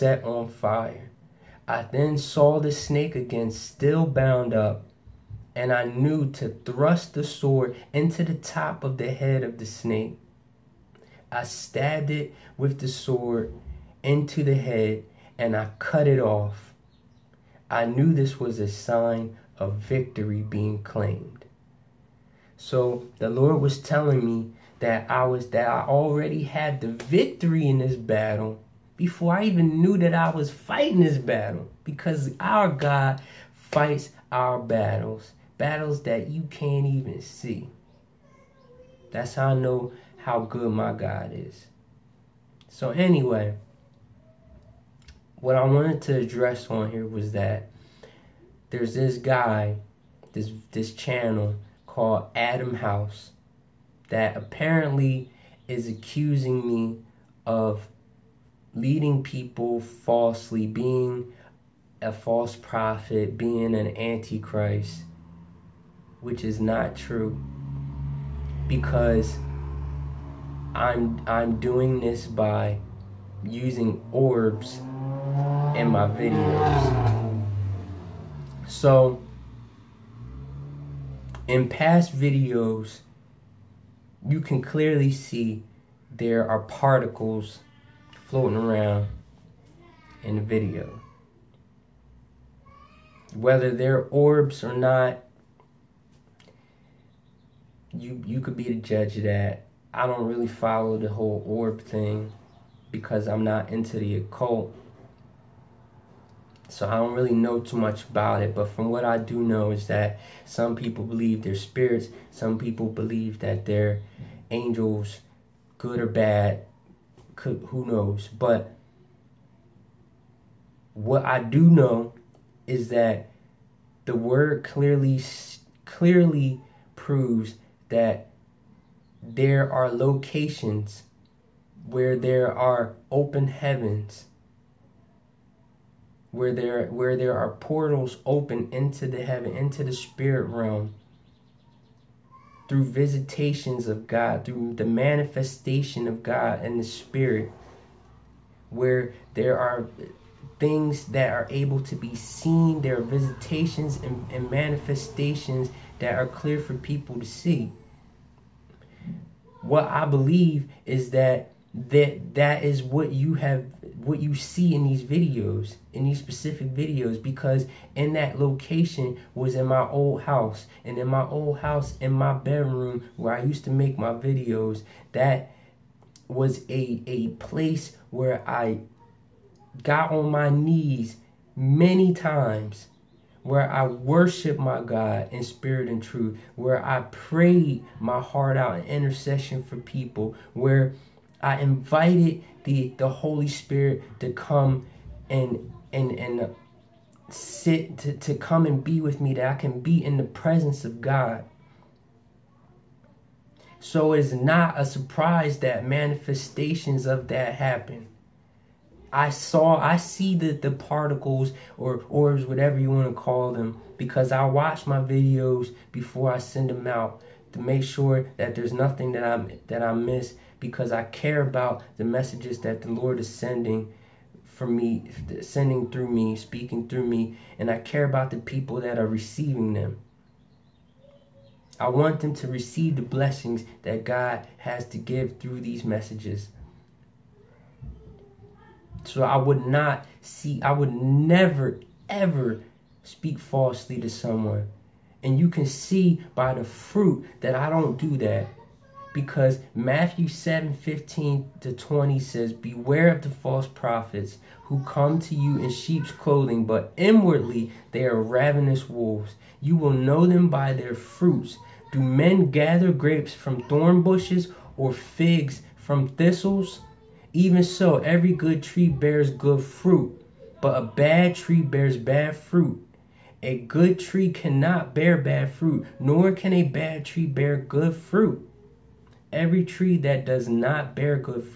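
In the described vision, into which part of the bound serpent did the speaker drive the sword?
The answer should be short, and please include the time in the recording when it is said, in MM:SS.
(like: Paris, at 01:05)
Top of the head, at 00:08.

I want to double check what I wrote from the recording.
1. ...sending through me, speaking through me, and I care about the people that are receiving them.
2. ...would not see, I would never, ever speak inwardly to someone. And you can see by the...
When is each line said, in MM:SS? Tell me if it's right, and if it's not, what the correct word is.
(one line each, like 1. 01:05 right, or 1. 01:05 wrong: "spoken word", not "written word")
1. 03:45 right
2. 03:59 wrong: "falsely", not "inwardly".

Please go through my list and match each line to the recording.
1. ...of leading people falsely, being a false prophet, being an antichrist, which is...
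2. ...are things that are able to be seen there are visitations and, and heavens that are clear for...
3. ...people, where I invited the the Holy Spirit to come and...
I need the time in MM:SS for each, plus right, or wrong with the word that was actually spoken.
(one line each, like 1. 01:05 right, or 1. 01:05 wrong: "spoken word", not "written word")
1. 00:57 right
2. 02:29 wrong: "manifestations", not "heavens"
3. 03:09 right.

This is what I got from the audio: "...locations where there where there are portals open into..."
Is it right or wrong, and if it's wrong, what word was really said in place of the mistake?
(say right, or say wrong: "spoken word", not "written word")
wrong: "heavens", not "locations".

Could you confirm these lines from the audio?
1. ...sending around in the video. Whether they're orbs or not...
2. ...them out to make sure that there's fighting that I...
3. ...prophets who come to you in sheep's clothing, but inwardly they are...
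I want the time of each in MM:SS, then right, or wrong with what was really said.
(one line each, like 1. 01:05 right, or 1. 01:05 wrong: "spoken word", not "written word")
1. 01:28 wrong: "floating", not "sending"
2. 03:36 wrong: "nothing", not "fighting"
3. 04:13 right.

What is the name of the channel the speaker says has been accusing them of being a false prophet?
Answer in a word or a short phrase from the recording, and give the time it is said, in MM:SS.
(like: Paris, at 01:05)
Adam House, at 00:52.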